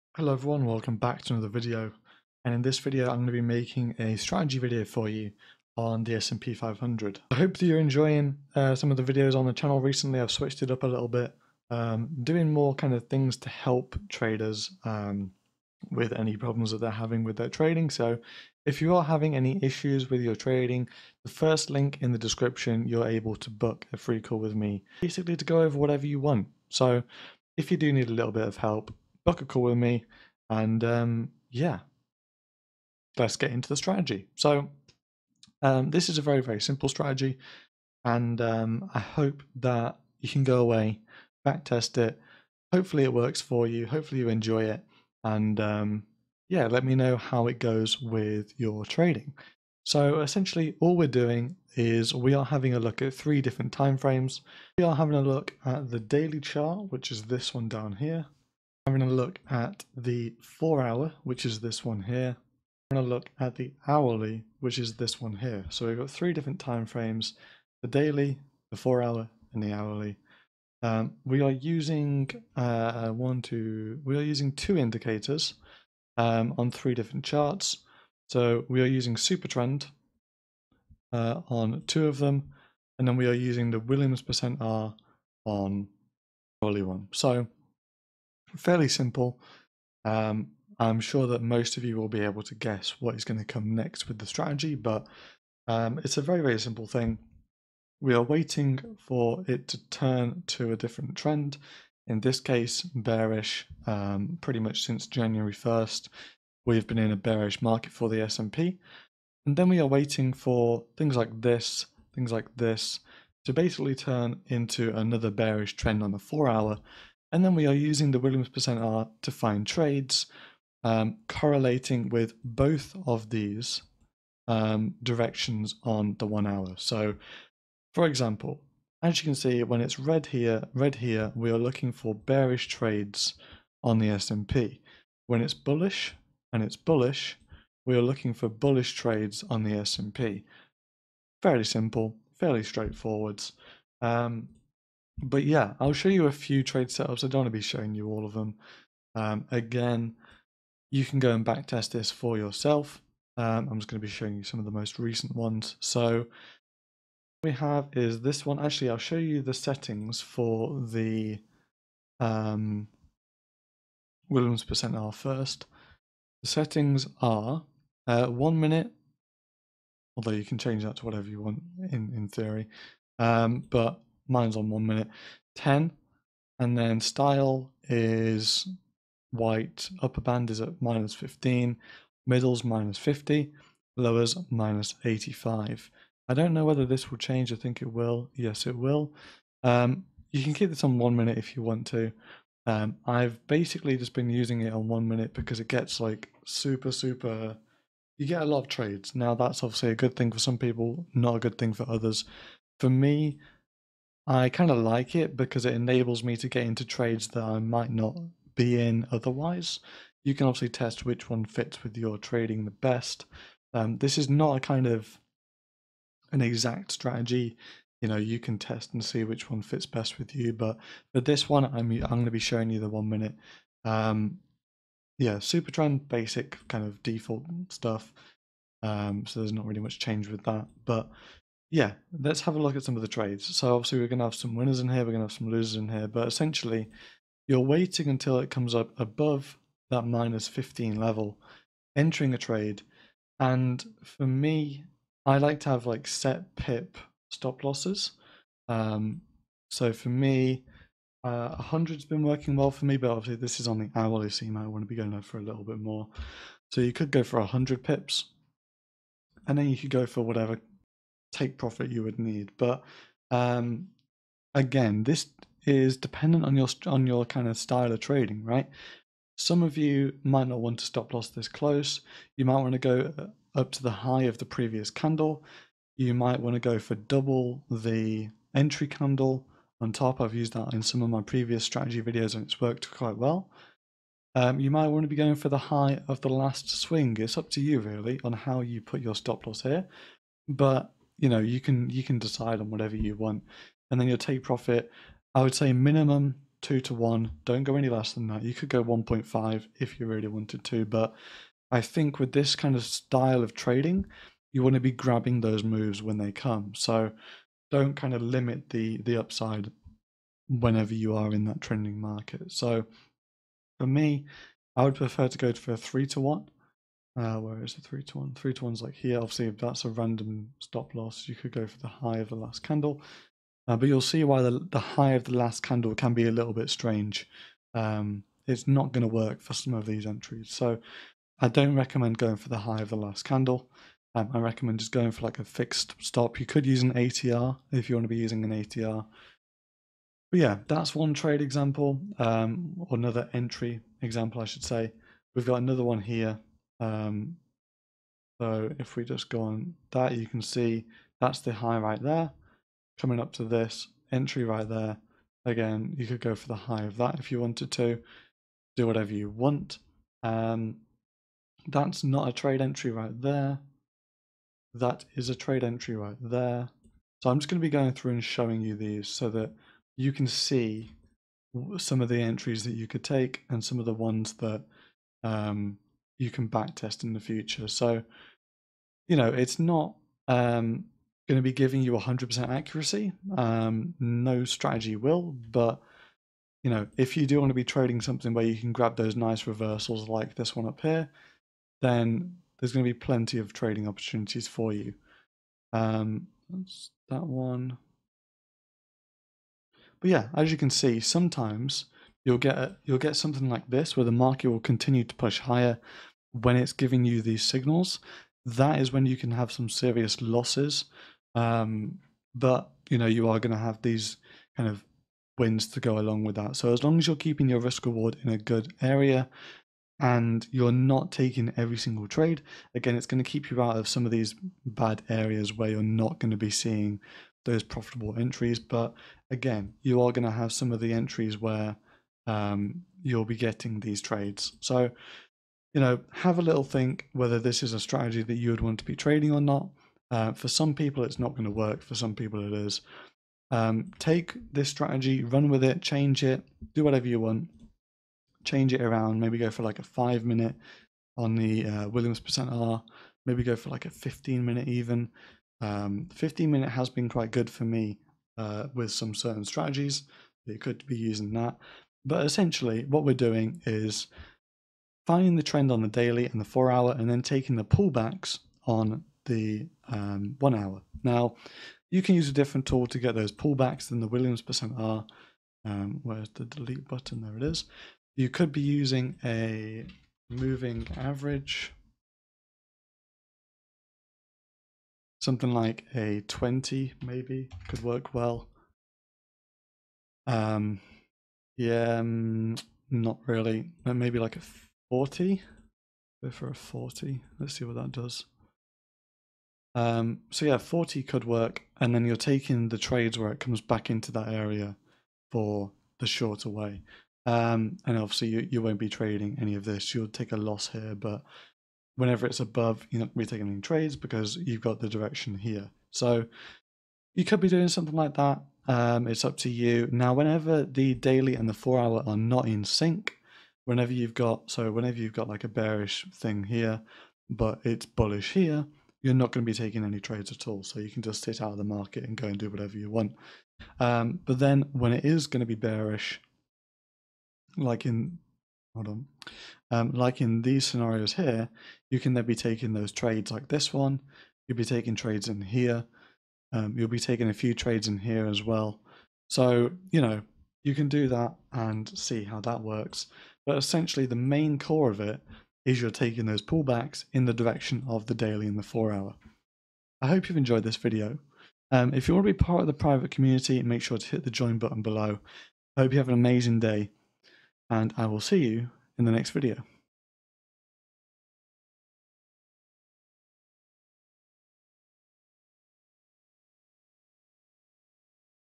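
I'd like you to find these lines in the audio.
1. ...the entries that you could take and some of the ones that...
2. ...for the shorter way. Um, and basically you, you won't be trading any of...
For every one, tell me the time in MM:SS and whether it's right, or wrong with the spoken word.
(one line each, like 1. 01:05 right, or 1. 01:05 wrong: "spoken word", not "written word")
1. 06:12 right
2. 08:25 wrong: "obviously", not "basically".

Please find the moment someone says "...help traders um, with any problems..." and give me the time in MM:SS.
00:13.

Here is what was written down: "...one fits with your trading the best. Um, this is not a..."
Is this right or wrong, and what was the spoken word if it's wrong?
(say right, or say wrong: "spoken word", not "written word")
right.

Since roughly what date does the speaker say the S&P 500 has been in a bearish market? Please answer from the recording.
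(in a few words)
January 1st.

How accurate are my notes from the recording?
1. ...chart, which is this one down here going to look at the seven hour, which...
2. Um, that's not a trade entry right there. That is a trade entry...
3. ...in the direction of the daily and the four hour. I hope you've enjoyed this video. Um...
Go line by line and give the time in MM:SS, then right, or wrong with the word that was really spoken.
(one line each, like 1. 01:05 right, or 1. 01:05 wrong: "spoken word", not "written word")
1. 00:56 wrong: "four", not "seven"
2. 06:00 right
3. 09:17 right.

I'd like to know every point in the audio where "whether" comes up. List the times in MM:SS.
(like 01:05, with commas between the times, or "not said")
03:06, 07:17.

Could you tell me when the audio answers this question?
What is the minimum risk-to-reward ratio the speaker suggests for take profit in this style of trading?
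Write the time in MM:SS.
04:56.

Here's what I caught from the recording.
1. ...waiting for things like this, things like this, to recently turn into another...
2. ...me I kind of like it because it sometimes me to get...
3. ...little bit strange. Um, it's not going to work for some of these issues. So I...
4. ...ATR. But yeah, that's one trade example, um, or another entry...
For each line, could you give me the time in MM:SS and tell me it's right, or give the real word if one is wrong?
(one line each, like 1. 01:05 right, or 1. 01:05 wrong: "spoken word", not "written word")
1. 01:49 wrong: "basically", not "recently"
2. 03:22 wrong: "enables", not "sometimes"
3. 05:26 wrong: "entries", not "issues"
4. 05:38 right.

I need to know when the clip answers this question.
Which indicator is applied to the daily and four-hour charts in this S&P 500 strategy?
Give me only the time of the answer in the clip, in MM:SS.
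01:19.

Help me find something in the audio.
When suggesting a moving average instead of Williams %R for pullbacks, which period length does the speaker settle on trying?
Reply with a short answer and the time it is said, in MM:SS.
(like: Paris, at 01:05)
40, at 08:16.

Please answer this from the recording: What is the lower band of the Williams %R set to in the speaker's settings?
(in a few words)
-85.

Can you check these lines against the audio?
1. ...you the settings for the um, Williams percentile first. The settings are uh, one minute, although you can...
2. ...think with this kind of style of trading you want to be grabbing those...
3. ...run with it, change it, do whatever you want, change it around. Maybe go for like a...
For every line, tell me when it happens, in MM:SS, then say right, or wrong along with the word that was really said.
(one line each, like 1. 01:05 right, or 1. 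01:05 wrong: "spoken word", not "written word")
1. 02:39 right
2. 05:01 right
3. 07:25 right.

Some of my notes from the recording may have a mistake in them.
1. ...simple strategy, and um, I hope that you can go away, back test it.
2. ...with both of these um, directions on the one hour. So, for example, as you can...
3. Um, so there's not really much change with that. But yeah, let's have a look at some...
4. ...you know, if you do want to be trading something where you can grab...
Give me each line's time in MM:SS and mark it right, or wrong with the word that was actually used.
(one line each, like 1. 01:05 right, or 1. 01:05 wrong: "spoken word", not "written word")
1. 00:36 right
2. 02:02 right
3. 03:48 right
4. 06:26 right.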